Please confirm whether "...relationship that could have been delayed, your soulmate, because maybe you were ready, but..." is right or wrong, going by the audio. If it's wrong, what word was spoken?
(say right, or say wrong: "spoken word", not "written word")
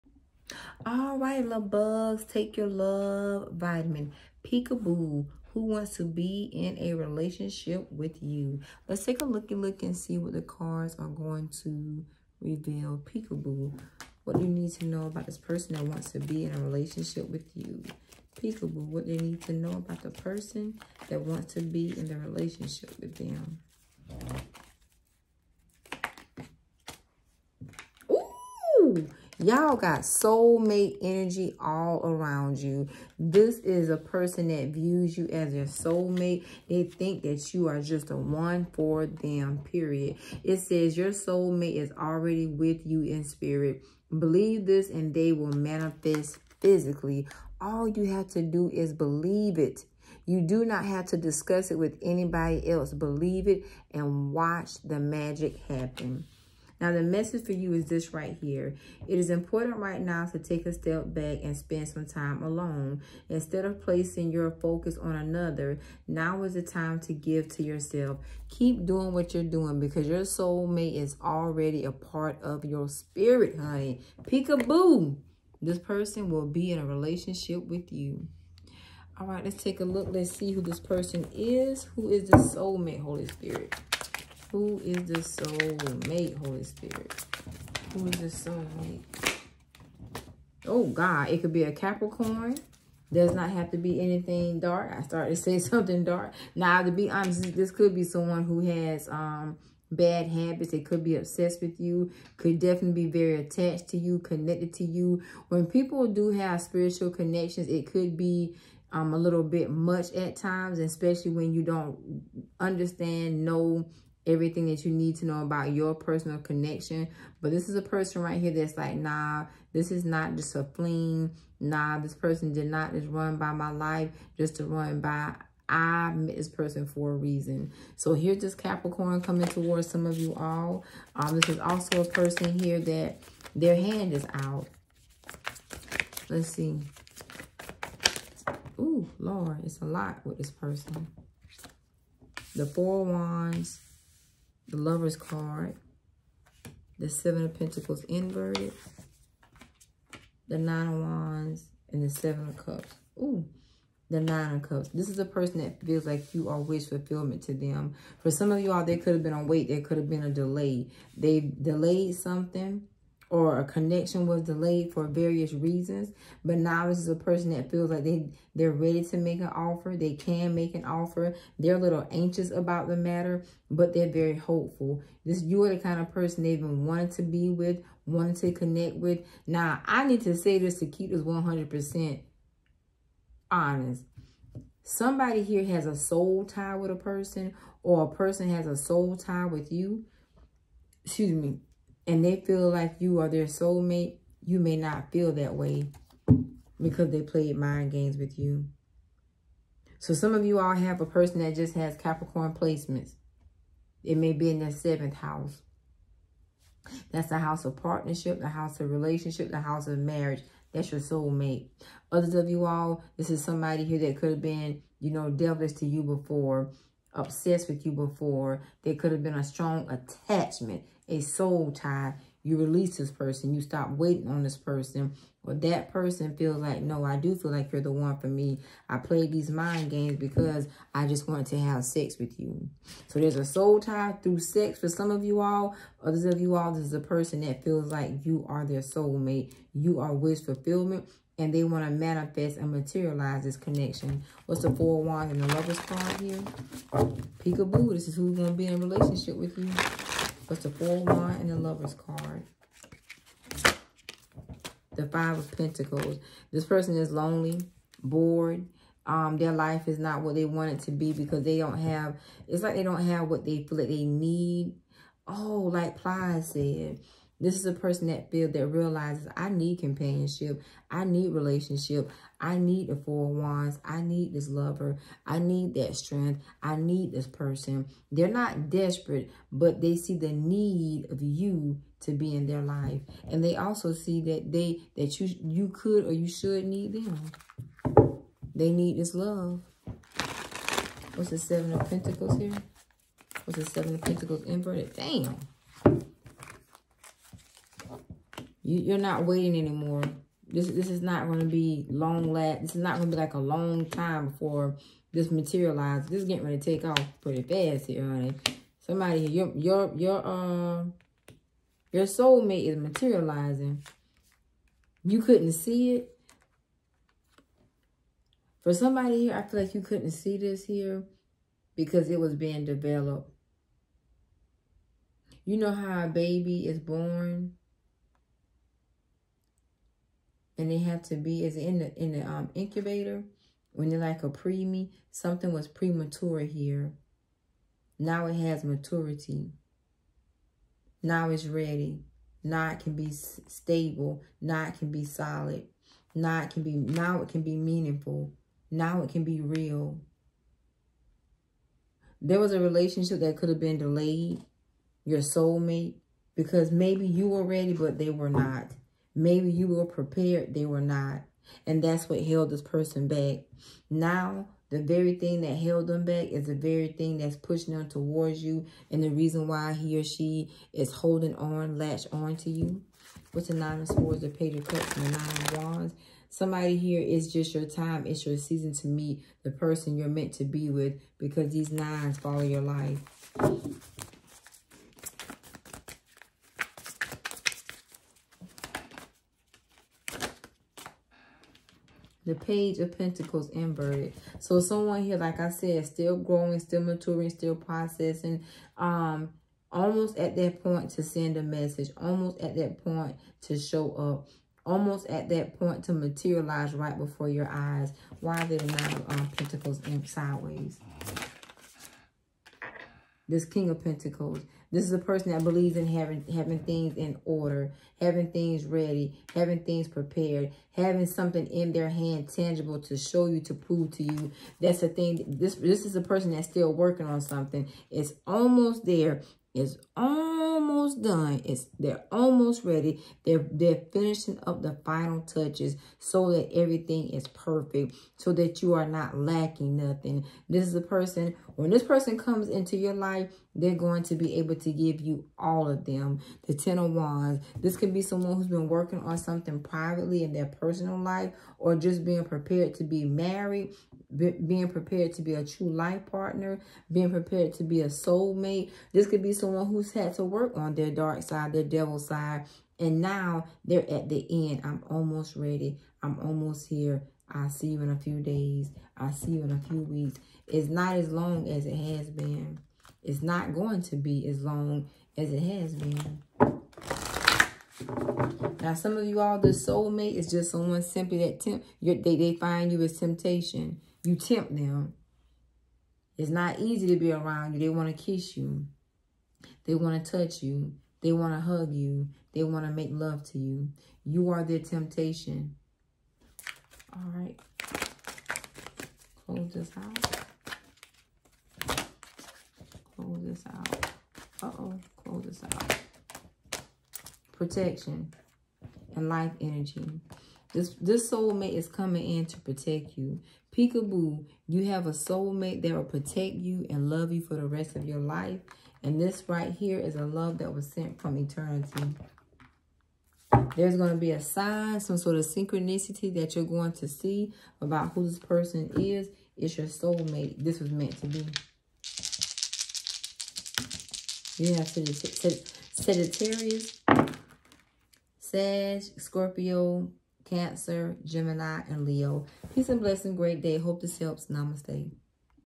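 right.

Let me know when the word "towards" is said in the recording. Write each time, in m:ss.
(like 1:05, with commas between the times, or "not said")
2:09, 6:07.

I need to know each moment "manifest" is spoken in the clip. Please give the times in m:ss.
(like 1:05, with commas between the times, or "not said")
0:45, 4:01.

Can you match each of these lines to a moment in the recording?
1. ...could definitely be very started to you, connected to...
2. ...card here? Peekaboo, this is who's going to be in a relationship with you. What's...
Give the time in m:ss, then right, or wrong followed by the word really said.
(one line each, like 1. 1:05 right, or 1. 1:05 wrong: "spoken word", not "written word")
1. 1:42 wrong: "attached", not "started"
2. 4:05 right.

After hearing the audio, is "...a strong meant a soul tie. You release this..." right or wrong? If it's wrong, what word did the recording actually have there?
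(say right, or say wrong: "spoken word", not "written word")
wrong: "attachment", not "meant".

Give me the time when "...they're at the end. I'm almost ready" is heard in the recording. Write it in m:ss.
7:43.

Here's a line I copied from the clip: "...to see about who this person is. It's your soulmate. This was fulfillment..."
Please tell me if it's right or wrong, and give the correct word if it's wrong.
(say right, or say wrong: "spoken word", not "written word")
wrong: "meant", not "fulfillment".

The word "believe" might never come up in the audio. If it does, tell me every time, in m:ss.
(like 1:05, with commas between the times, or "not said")
0:44, 0:48, 0:52, 6:55.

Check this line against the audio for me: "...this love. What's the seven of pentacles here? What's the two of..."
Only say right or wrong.
wrong.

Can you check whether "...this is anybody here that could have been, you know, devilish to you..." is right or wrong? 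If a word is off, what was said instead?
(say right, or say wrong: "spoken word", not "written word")
wrong: "somebody", not "anybody".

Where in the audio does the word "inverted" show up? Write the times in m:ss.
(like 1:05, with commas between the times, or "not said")
2:28, 4:54, 6:33.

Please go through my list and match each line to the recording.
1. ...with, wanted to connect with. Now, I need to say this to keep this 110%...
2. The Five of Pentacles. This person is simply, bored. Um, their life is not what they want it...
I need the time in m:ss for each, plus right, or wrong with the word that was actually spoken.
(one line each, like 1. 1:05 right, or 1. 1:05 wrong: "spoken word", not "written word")
1. 2:57 wrong: "100", not "110"
2. 4:14 wrong: "lonely", not "simply".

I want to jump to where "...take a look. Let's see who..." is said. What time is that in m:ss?
1:19.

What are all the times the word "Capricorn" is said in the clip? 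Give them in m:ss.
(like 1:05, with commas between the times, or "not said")
1:31, 2:08, 3:21.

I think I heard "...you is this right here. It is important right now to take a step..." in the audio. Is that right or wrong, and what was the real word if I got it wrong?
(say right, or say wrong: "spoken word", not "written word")
right.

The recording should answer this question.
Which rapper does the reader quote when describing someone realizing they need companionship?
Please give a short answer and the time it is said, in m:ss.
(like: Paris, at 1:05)
Plies, at 4:25.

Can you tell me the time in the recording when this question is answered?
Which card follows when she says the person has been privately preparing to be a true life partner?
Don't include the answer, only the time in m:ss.
7:26.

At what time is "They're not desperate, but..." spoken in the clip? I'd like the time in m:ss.
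4:38.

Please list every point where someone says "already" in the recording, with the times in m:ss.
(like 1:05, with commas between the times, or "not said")
0:41, 1:11.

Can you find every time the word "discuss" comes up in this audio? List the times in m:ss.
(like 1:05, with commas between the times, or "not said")
0:51.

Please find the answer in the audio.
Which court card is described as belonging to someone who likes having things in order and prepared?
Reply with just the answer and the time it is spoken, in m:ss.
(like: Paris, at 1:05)
King of Pentacles, at 6:53.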